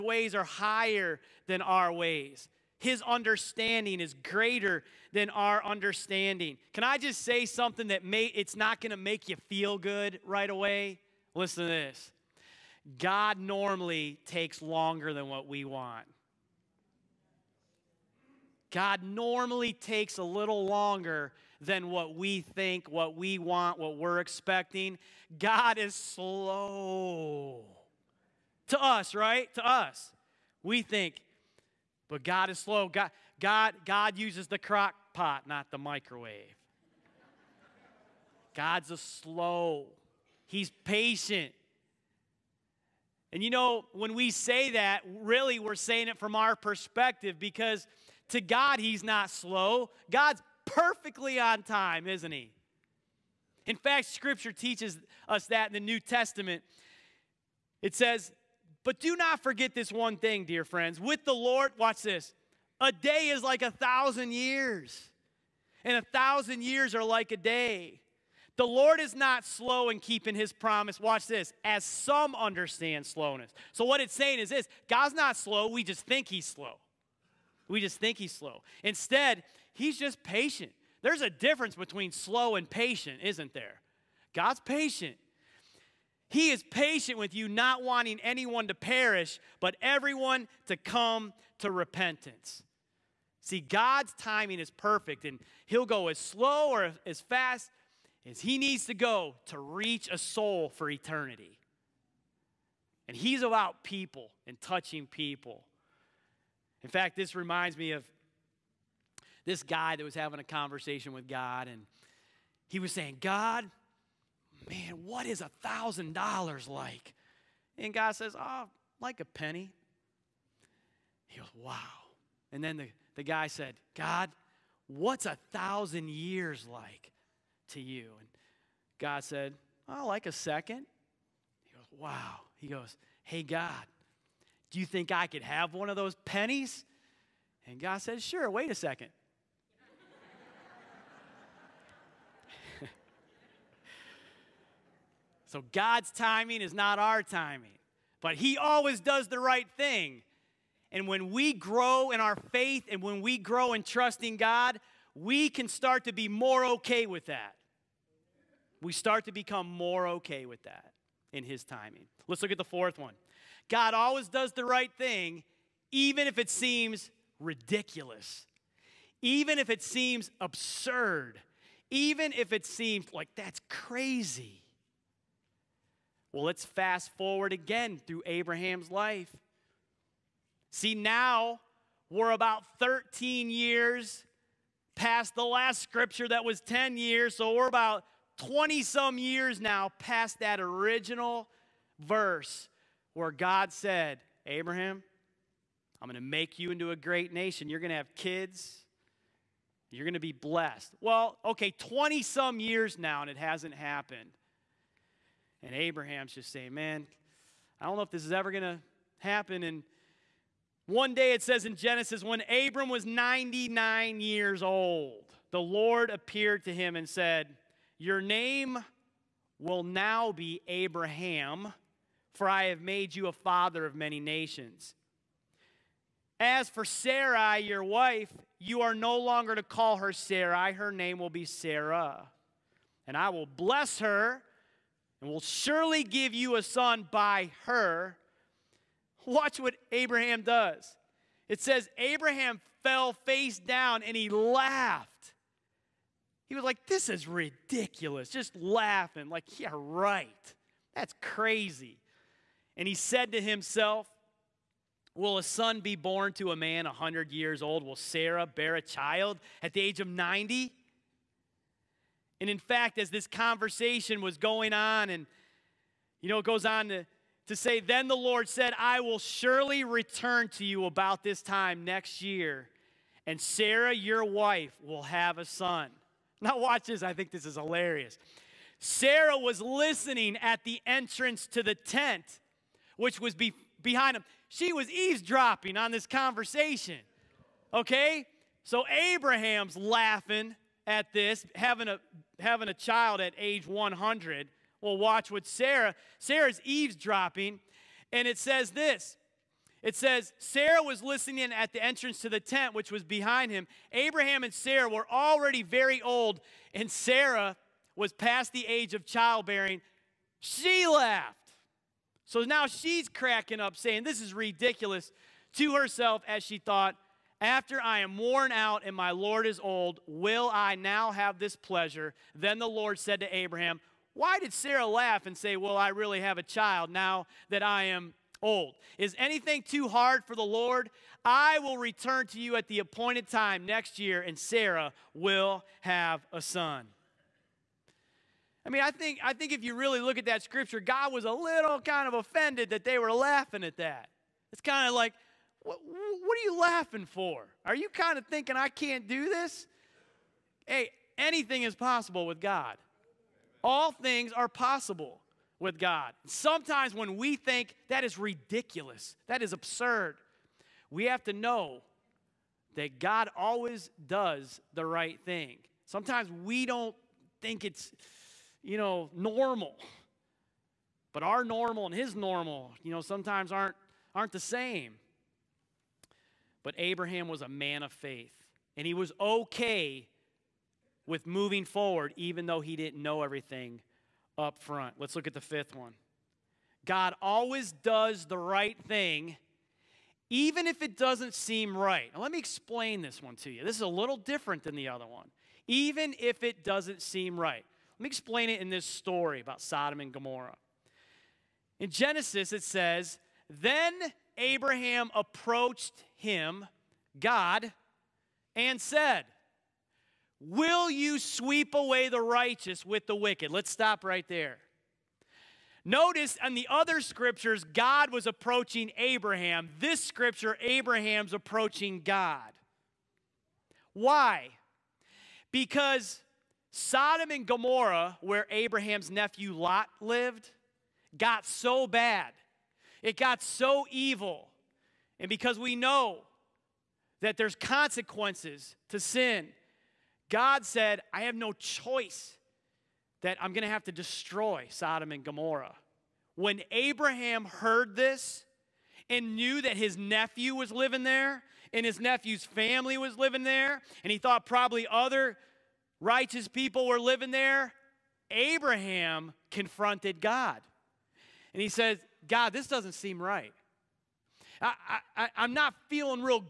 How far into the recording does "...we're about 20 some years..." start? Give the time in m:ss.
3:07.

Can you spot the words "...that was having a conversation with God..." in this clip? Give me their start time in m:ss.
1:49.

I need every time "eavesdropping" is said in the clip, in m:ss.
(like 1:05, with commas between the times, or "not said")
4:44, 4:56.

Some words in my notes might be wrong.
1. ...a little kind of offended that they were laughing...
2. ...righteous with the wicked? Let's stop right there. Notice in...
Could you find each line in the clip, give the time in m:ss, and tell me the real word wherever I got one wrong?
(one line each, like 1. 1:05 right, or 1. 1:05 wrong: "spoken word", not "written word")
1. 5:41 right
2. 6:52 right.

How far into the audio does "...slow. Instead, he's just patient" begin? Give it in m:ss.
1:18.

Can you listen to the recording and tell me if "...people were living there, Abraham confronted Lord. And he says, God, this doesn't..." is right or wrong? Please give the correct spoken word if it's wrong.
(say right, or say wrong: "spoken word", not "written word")
wrong: "God", not "Lord".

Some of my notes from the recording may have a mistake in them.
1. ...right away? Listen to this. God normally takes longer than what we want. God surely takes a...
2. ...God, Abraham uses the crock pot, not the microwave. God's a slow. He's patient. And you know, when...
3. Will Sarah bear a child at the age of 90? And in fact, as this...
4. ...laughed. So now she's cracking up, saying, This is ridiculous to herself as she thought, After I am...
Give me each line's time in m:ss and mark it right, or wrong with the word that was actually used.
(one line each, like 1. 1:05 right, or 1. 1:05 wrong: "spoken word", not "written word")
1. 0:10 wrong: "normally", not "surely"
2. 0:33 wrong: "God", not "Abraham"
3. 4:17 right
4. 5:10 right.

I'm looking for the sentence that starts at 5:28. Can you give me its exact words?
Is anything too hard for the Lord?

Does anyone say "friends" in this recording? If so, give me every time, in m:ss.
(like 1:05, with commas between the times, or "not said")
1:00.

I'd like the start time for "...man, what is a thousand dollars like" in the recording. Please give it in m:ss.
1:54.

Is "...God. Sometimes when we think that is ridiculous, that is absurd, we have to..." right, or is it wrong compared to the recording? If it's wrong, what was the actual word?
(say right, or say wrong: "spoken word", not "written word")
right.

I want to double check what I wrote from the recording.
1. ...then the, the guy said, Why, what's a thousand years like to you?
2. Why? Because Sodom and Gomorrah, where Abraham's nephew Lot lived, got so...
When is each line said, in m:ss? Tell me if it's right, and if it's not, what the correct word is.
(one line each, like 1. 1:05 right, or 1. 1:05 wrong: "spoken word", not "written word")
1. 2:02 wrong: "God", not "Why"
2. 7:03 right.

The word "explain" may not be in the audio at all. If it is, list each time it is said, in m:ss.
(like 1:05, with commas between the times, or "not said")
6:32, 6:38.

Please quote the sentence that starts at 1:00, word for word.
With the Lord, watch this a day is like a thousand years, and a thousand years are like a day.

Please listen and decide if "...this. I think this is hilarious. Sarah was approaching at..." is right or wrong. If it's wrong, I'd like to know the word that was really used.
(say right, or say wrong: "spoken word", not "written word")
wrong: "listening", not "approaching".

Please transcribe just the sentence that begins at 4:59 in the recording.
It says, Sarah was listening at the entrance to the tent, which was behind him.